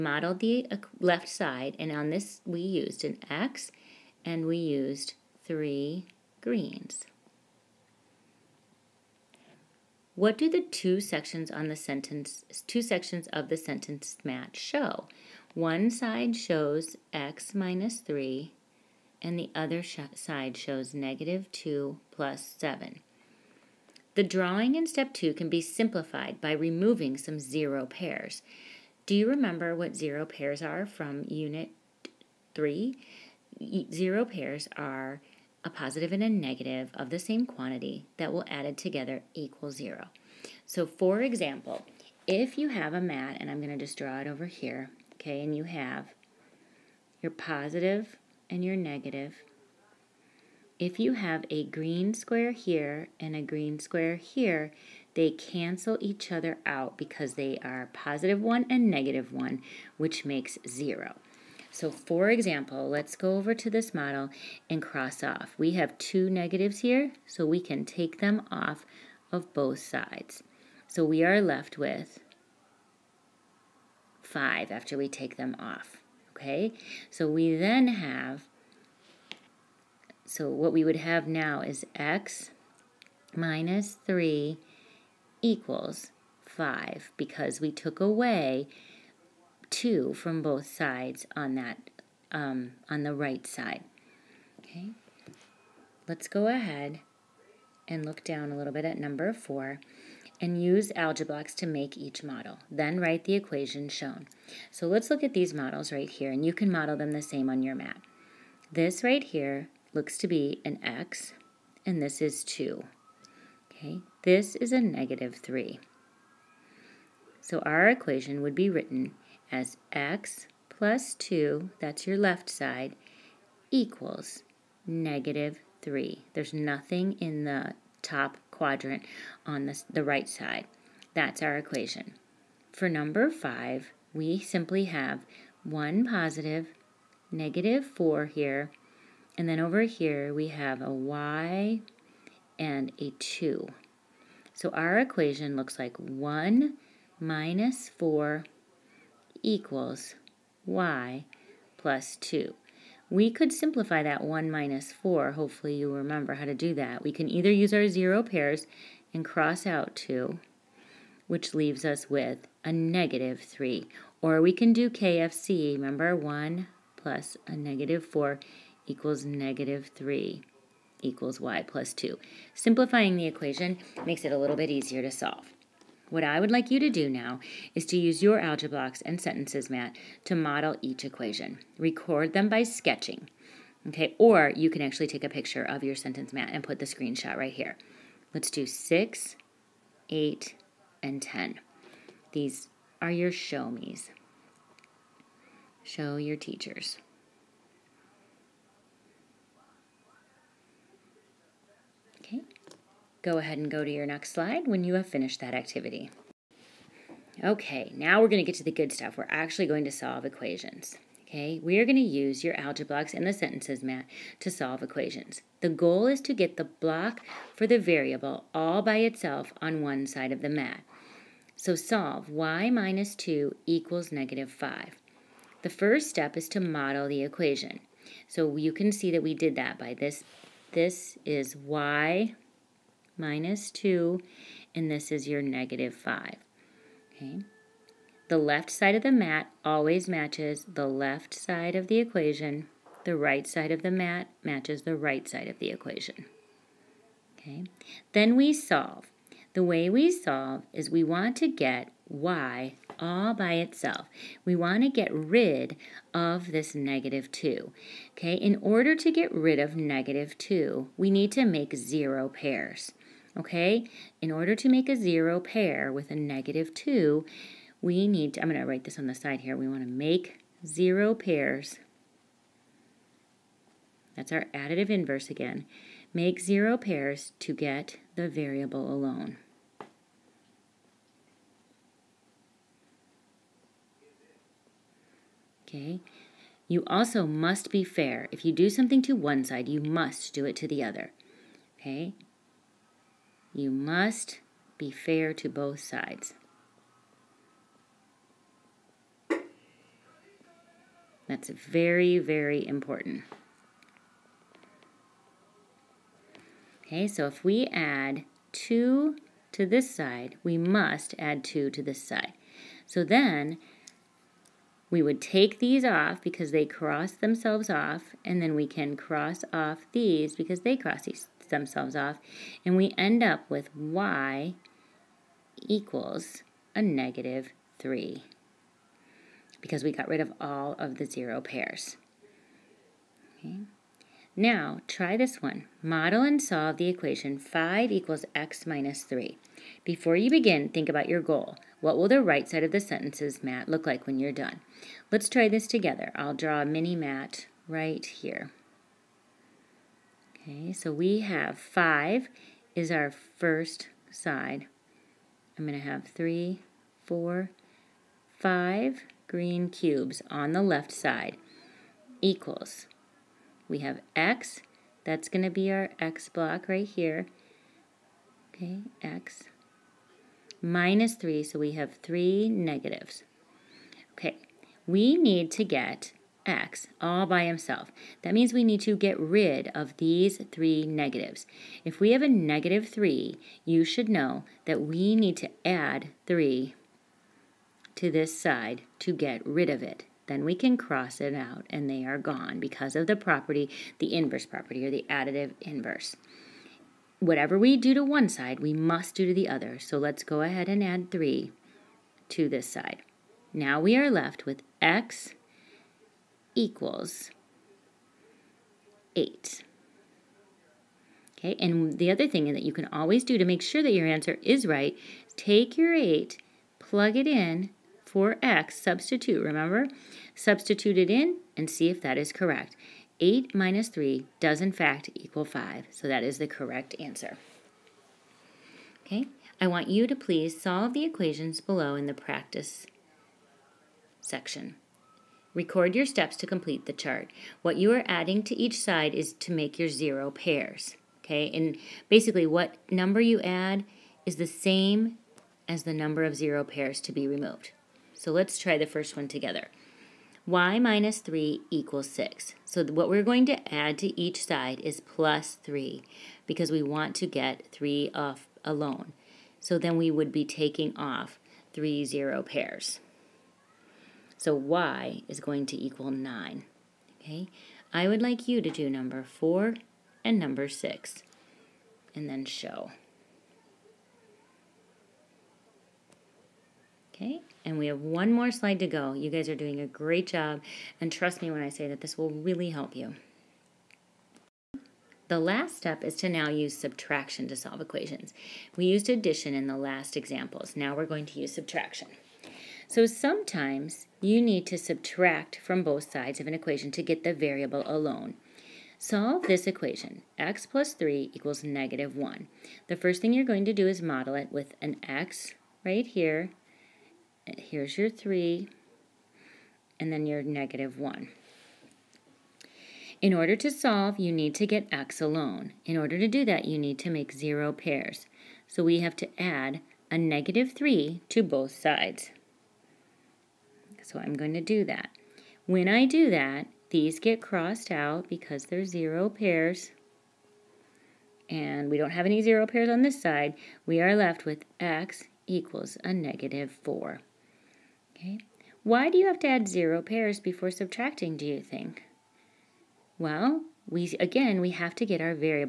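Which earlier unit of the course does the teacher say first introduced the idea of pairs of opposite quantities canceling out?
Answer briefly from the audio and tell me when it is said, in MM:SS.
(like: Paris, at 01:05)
Unit 3, at 00:31.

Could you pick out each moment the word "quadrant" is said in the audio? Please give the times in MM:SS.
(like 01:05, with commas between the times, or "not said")
02:08.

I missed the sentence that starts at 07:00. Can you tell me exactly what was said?
Substitute it in and see if that is correct.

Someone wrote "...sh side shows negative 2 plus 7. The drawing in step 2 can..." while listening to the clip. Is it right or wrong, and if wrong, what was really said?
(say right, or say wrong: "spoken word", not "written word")
right.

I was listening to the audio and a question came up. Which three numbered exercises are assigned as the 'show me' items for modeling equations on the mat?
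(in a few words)
6, 8, and 10.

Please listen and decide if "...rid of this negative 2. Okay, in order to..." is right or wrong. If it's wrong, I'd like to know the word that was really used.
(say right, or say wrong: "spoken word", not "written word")
right.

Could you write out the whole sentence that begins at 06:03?
We have x, that's going to be our x block right here.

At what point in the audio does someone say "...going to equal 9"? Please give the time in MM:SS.
07:45.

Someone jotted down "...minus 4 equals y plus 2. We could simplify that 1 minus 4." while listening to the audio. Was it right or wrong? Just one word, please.
right.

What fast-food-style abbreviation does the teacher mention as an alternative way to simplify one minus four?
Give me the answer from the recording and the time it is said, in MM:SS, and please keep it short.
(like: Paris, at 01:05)
KFC, at 02:44.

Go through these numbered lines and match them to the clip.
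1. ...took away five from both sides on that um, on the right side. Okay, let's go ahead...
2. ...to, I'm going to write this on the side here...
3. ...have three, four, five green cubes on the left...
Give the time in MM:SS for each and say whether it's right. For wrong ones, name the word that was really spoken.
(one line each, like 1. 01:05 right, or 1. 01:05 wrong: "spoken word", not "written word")
1. 01:27 wrong: "two", not "five"
2. 04:28 right
3. 05:55 right.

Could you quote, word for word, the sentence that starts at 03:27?
Okay, now we're going to get to the good stuff.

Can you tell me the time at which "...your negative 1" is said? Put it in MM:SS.
08:30.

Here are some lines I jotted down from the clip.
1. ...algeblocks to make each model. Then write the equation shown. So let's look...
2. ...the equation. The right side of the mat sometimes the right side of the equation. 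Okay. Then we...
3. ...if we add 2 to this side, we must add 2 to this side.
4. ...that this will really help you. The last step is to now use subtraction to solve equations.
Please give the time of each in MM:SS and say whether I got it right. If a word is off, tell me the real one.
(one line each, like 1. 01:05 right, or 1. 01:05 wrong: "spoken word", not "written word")
1. 01:40 right
2. 04:01 wrong: "matches", not "sometimes"
3. 05:07 right
4. 08:01 right.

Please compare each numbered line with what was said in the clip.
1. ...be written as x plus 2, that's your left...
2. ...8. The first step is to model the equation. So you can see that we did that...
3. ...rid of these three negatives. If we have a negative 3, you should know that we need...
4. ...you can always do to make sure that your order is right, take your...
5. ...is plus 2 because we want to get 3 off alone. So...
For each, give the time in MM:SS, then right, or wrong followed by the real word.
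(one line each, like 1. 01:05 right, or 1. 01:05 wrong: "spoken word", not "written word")
1. 01:58 right
2. 03:44 wrong: "5", not "8"
3. 06:19 right
4. 06:52 wrong: "answer", not "order"
5. 07:34 wrong: "3", not "2".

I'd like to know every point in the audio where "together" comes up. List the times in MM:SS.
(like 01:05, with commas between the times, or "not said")
00:38, 05:45, 07:29.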